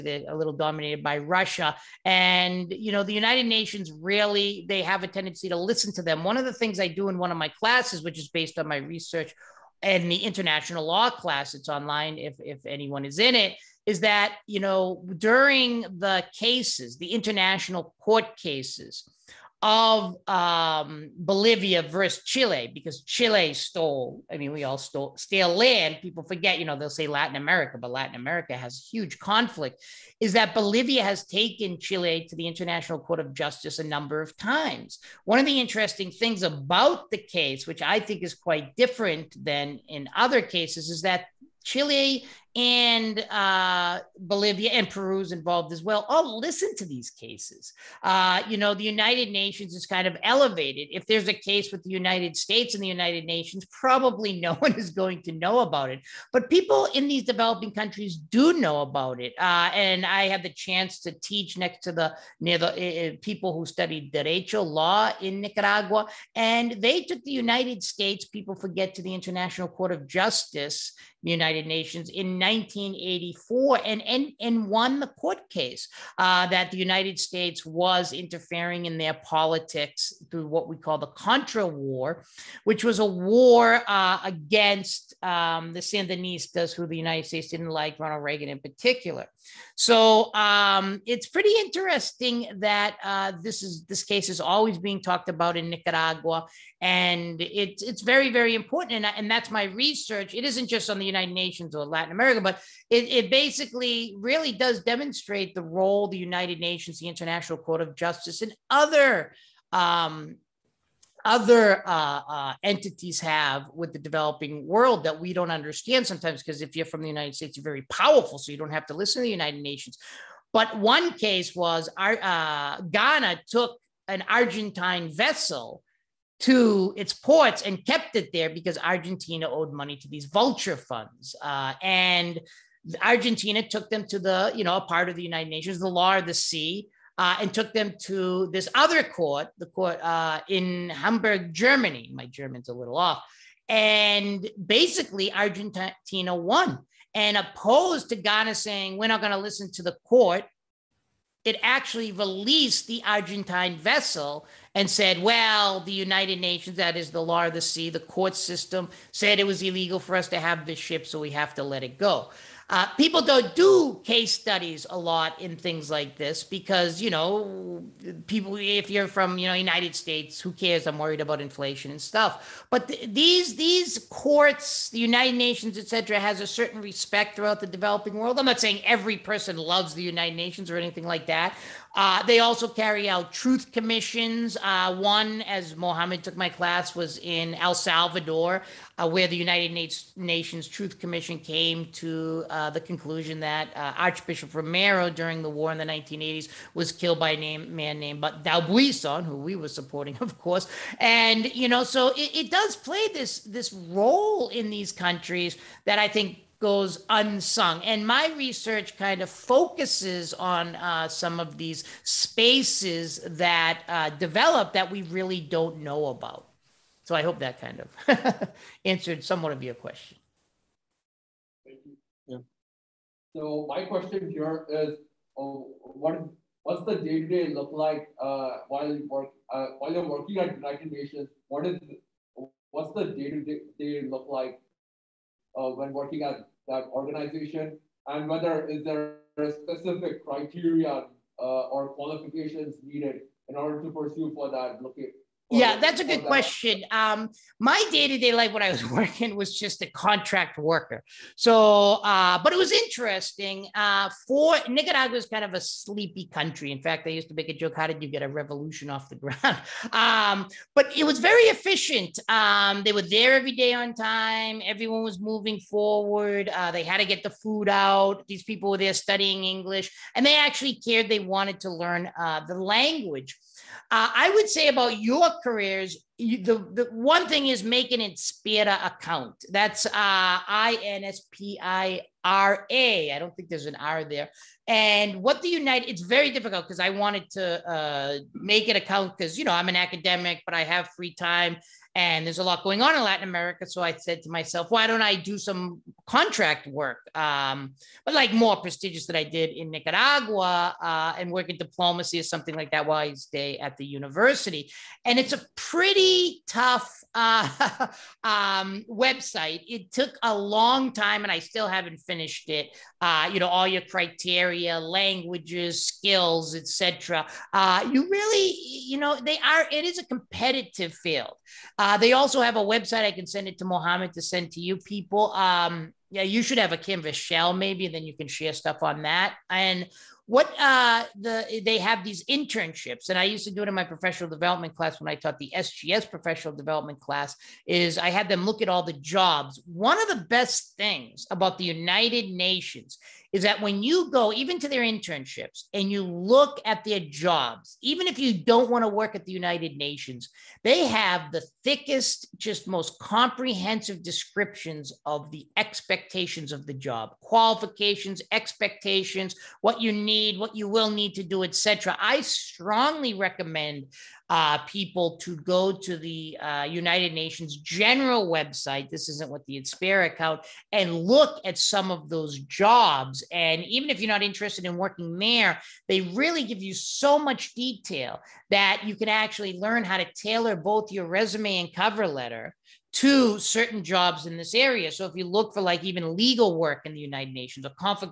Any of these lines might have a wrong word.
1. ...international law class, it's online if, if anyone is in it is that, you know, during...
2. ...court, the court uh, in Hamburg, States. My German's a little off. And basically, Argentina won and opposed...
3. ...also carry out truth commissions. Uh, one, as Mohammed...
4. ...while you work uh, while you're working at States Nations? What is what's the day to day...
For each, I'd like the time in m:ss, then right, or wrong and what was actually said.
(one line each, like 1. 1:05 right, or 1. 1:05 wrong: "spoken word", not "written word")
1. 0:10 right
2. 2:19 wrong: "Germany", not "States"
3. 3:02 right
4. 3:48 wrong: "United", not "States".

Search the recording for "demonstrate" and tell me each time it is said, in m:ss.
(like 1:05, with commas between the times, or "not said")
1:44.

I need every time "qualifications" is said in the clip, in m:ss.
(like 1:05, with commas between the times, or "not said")
4:01, 5:57.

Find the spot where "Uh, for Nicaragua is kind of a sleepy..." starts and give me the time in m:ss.
4:13.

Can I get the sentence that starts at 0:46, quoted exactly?
All oh, listen to these cases.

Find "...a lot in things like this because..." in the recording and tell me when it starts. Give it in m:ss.
2:44.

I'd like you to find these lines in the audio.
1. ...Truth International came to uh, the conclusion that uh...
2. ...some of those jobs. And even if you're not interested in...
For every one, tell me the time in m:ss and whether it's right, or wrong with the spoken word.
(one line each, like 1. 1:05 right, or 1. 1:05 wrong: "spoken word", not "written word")
1. 3:10 wrong: "Commission", not "International"
2. 6:11 right.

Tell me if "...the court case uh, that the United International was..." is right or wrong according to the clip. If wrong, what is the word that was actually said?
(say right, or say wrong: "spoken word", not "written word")
wrong: "States", not "International".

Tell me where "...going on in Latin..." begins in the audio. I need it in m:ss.
4:52.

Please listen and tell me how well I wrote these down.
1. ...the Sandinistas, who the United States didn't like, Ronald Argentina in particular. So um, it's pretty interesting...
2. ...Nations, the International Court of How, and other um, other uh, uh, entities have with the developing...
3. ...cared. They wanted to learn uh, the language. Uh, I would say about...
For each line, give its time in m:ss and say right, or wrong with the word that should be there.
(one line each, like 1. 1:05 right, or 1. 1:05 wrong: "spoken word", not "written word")
1. 1:25 wrong: "Reagan", not "Argentina"
2. 1:46 wrong: "Justice", not "How"
3. 4:30 right.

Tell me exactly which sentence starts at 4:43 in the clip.
I don't think there's an R there.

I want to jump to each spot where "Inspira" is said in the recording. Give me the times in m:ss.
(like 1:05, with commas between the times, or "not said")
4:38, 6:09.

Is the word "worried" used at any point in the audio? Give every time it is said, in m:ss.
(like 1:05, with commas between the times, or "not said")
2:50.